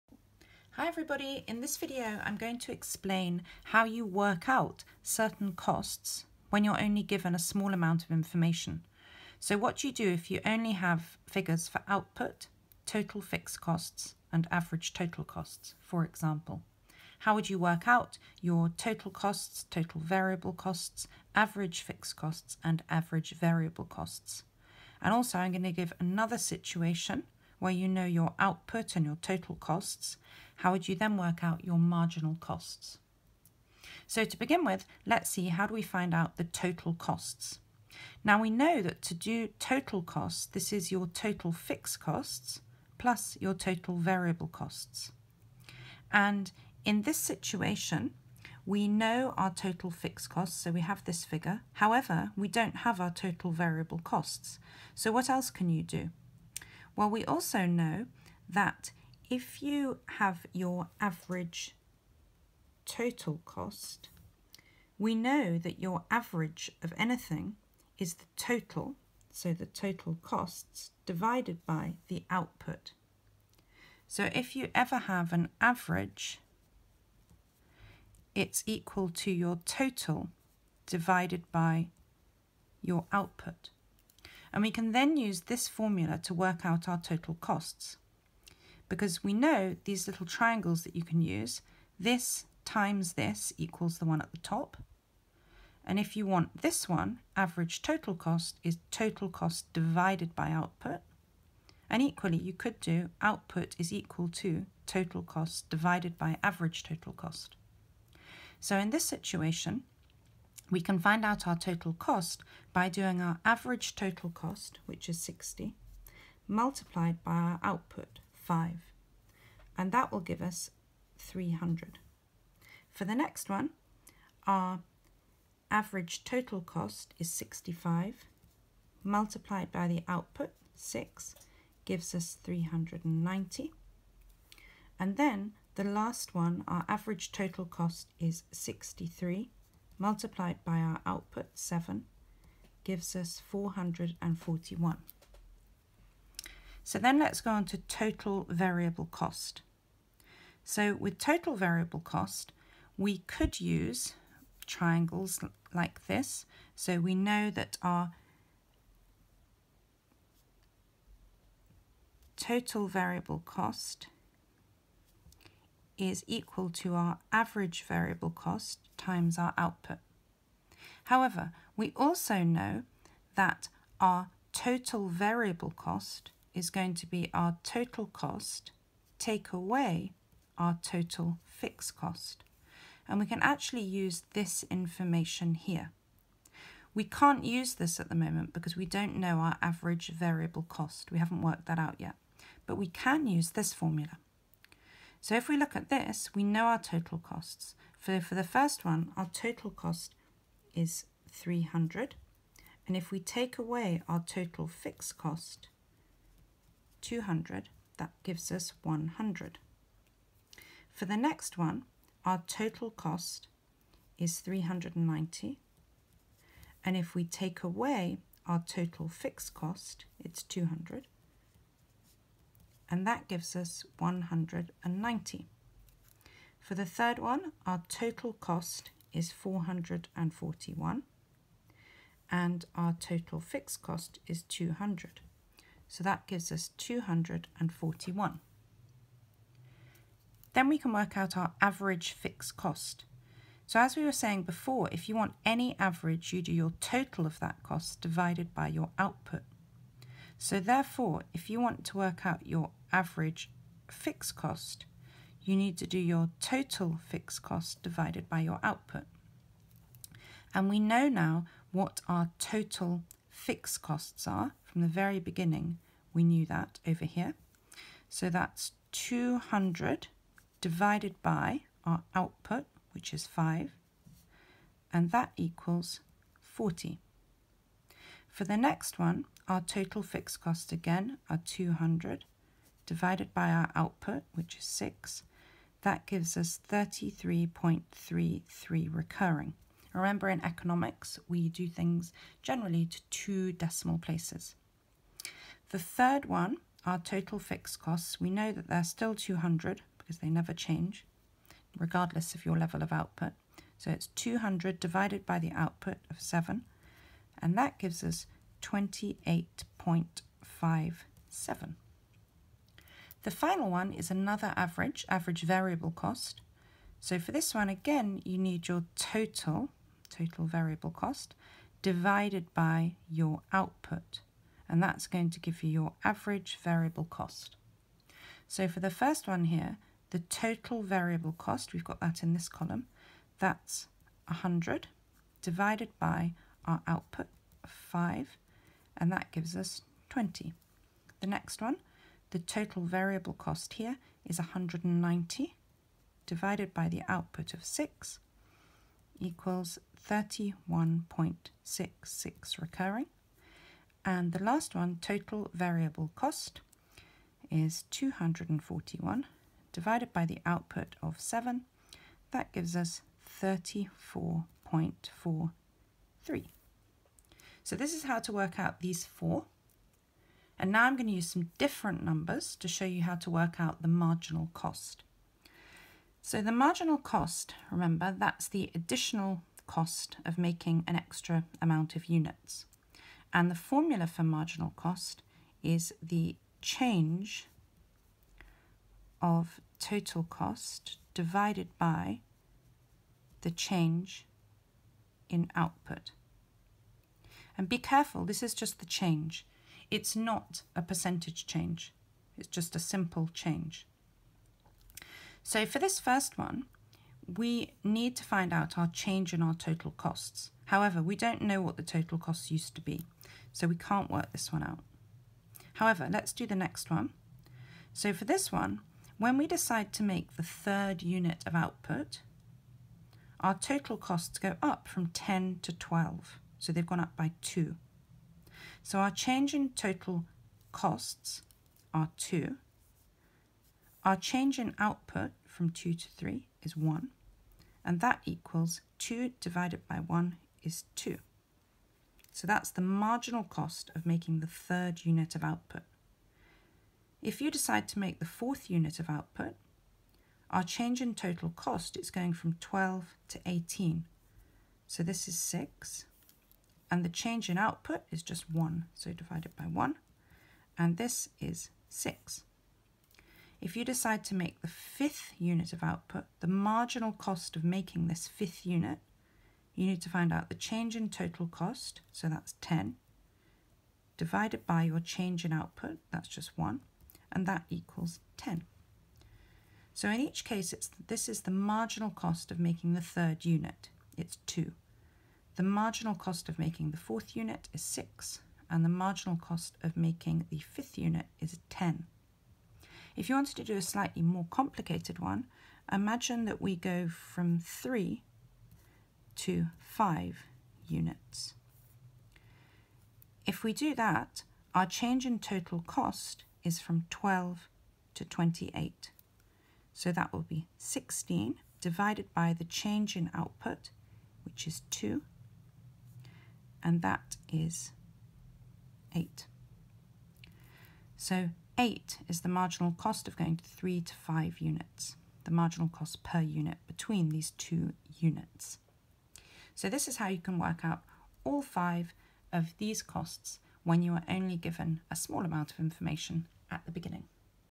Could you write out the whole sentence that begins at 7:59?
So in each case, it's, this is the marginal cost of making the third unit, it's 2.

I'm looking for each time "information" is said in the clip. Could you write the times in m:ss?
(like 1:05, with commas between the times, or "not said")
0:08, 3:04, 8:55.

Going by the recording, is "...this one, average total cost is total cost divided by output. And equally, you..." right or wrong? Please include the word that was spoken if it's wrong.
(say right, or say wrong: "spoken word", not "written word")
right.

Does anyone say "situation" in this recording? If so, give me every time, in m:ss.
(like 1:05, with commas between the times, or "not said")
0:26, 0:47, 1:49.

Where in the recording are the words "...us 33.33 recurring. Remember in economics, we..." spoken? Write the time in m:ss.
4:46.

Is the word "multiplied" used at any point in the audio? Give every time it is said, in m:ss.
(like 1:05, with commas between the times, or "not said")
1:56, 2:09, 2:19.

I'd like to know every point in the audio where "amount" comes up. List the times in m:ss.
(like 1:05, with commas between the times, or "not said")
0:07, 6:21, 8:55.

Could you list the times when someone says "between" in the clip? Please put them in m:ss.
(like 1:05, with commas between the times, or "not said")
8:46.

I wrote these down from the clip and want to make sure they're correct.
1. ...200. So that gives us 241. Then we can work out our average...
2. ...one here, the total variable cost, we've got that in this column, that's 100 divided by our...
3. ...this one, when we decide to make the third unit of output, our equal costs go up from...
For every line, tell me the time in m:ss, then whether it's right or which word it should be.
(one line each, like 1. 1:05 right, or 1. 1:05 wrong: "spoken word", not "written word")
1. 3:54 right
2. 5:29 right
3. 6:58 wrong: "total", not "equal".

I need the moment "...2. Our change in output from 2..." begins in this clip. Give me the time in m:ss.
7:12.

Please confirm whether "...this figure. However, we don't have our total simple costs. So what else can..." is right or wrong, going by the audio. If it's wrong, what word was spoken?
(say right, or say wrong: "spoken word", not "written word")
wrong: "variable", not "simple".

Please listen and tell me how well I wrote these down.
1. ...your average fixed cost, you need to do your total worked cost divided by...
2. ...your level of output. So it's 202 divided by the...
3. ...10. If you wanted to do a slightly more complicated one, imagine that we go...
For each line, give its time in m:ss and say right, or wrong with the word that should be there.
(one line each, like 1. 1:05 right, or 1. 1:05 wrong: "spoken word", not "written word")
1. 4:12 wrong: "fixed", not "worked"
2. 5:02 wrong: "200", not "202"
3. 8:11 right.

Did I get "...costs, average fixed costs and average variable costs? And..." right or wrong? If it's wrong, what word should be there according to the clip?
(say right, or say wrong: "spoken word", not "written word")
right.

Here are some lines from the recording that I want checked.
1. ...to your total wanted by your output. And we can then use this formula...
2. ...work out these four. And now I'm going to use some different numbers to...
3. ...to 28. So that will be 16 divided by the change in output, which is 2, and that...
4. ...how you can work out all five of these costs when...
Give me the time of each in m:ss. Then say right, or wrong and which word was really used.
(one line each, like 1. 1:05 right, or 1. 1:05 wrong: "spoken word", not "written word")
1. 1:19 wrong: "divided", not "wanted"
2. 6:08 right
3. 8:28 right
4. 8:50 right.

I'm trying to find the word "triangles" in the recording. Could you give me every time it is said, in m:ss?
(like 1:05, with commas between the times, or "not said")
1:30, 2:34.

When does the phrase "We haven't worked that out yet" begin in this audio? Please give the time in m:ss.
3:11.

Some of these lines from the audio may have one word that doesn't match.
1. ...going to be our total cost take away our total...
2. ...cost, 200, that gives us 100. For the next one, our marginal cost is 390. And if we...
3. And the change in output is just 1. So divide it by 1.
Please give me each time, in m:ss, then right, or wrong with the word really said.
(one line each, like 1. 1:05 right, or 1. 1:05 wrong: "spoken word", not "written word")
1. 2:56 right
2. 3:25 wrong: "total", not "marginal"
3. 7:36 right.